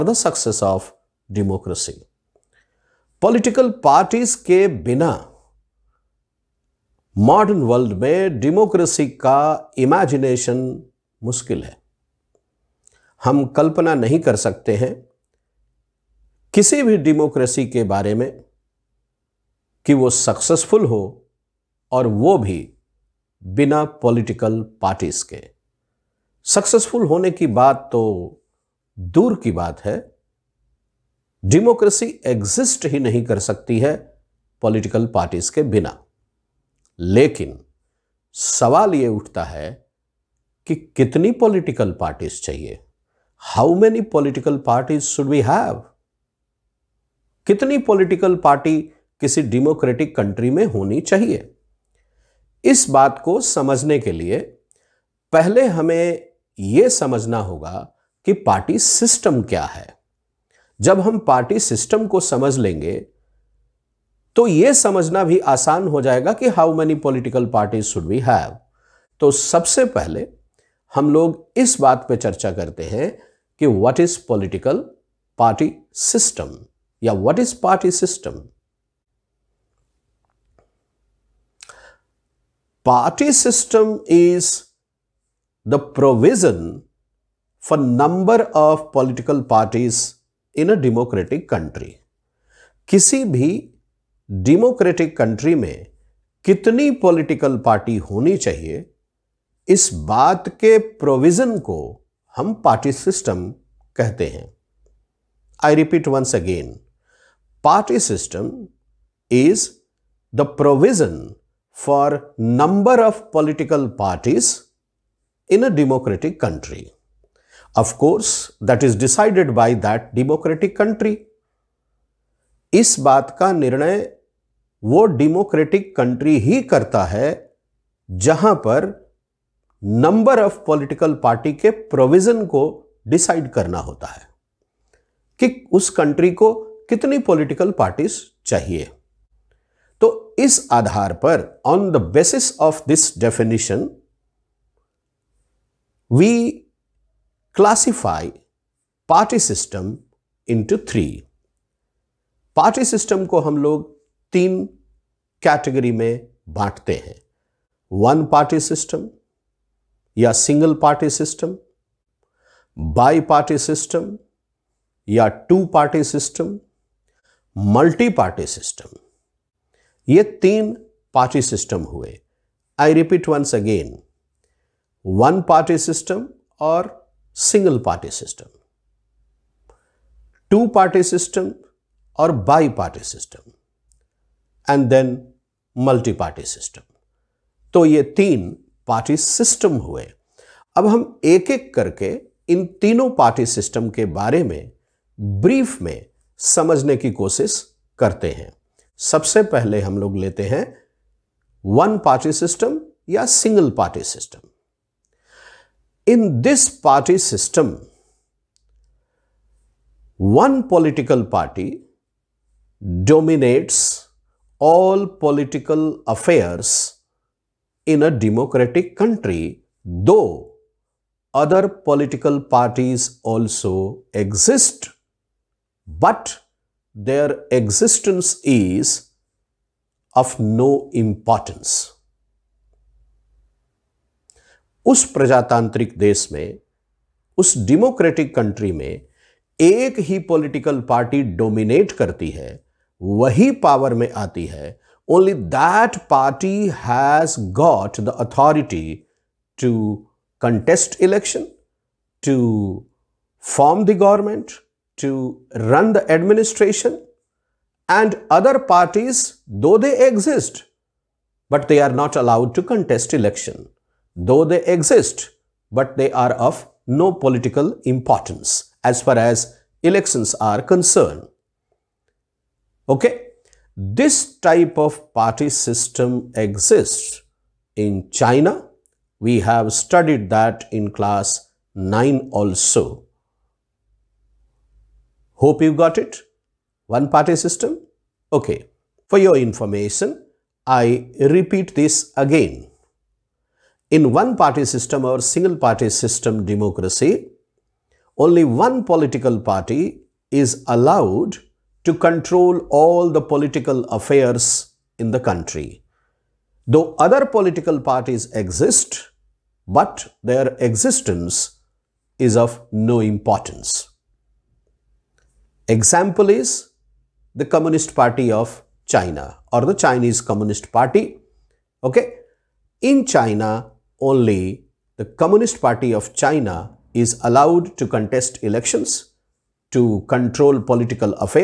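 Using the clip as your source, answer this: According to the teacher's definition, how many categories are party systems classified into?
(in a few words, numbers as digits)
3.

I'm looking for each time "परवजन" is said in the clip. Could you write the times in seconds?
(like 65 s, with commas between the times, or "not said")
85 s, 101 s, 110 s, 131 s.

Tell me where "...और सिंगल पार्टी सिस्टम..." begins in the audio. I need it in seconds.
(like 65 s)
176 s.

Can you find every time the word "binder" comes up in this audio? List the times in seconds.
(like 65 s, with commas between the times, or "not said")
not said.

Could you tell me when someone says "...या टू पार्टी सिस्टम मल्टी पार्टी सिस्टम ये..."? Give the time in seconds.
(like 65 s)
165 s.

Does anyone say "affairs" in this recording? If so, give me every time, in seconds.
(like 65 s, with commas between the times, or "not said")
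216 s, 303 s.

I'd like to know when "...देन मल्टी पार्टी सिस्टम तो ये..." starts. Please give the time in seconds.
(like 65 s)
184 s.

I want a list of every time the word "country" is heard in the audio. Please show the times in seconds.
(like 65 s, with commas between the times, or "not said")
218 s, 238 s, 305 s.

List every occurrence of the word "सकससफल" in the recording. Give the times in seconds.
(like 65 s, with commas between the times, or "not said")
20 s, 26 s.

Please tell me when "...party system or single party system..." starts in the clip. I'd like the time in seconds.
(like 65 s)
294 s.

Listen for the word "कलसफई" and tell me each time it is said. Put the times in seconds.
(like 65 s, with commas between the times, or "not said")
147 s.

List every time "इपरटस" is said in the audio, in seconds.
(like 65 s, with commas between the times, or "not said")
267 s.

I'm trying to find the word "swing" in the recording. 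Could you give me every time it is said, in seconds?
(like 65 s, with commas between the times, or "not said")
not said.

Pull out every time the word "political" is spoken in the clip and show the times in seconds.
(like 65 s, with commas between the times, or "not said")
3 s, 215 s, 221 s, 240 s, 298 s, 303 s, 307 s, 330 s.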